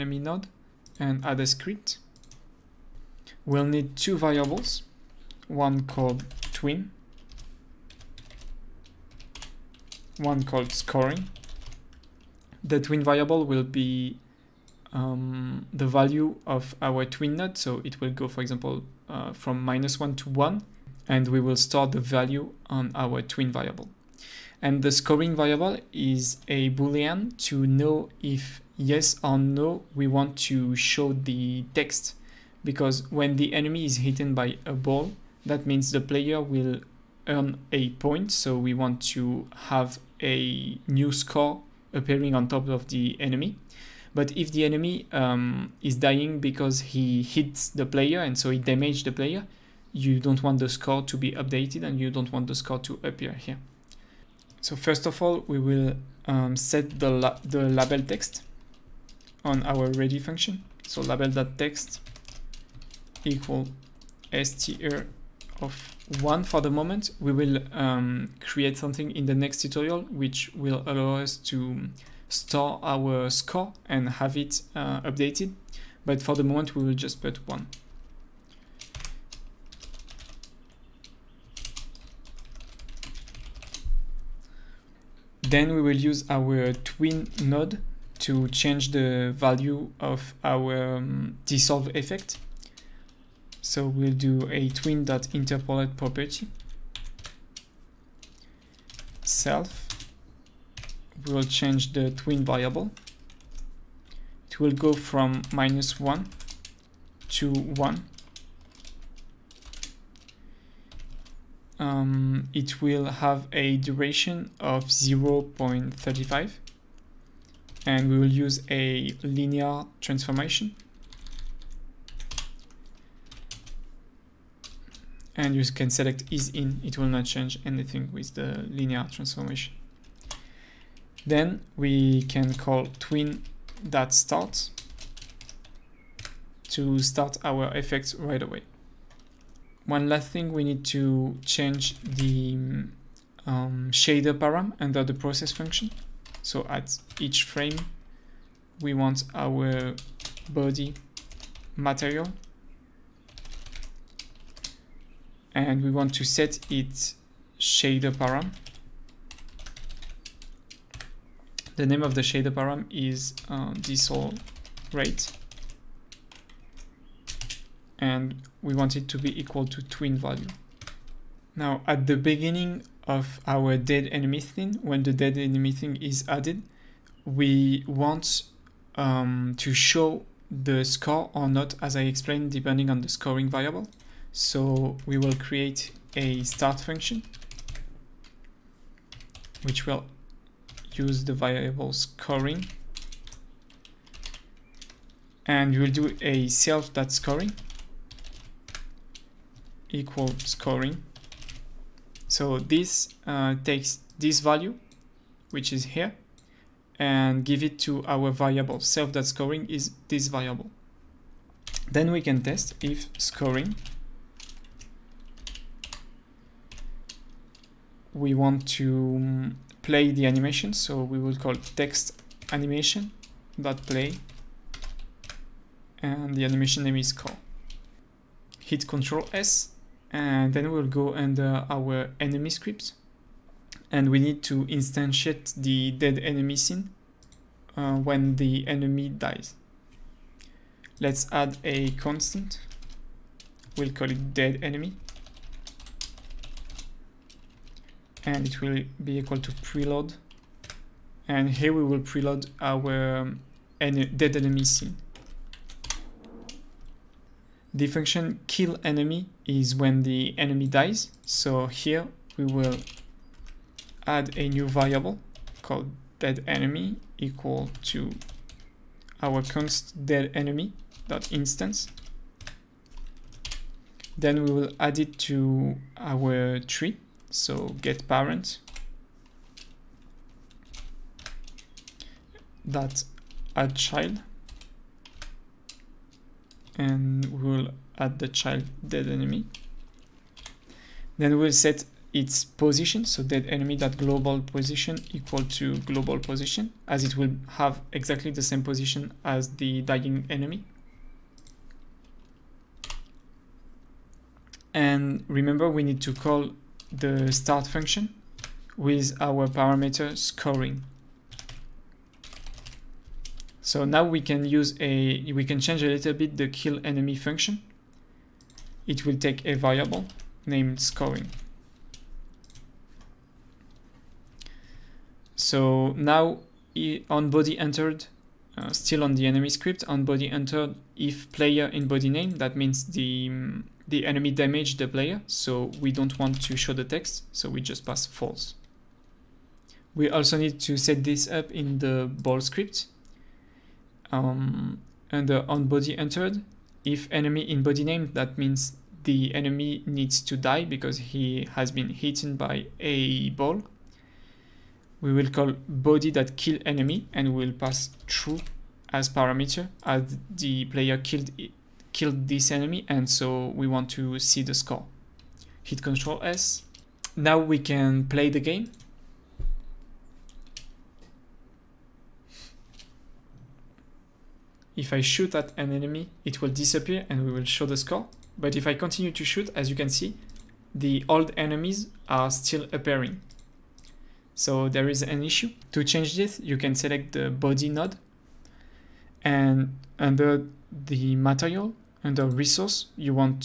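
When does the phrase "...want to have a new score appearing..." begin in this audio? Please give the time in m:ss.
0:38.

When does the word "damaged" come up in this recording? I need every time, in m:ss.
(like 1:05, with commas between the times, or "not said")
0:48, 5:34.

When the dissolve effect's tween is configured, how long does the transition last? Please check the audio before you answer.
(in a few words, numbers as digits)
0.35.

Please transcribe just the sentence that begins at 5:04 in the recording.
And remember, we need to call the start function with our parameter scoring.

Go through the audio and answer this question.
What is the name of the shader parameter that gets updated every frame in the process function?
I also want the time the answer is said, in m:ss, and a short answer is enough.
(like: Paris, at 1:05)
dissolve rate, at 2:43.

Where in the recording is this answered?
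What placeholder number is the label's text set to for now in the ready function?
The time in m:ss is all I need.
1:04.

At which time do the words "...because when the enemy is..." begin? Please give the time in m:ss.
0:32.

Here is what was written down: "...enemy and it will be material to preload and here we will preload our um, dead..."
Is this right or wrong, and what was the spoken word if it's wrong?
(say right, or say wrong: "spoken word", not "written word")
wrong: "equal", not "material".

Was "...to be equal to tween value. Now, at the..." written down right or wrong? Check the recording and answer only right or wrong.
right.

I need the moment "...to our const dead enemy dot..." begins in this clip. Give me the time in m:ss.
4:27.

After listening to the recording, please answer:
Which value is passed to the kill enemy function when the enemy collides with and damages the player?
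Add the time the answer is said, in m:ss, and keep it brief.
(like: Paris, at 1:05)
false, at 5:38.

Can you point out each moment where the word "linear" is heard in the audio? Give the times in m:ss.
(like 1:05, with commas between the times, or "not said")
1:59, 2:08.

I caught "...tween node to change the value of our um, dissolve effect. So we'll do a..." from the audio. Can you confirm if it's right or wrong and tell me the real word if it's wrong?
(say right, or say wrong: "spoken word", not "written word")
right.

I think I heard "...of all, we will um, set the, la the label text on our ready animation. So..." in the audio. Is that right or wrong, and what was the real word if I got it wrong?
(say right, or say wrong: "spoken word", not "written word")
wrong: "function", not "animation".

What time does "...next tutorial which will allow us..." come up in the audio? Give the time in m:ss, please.
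1:09.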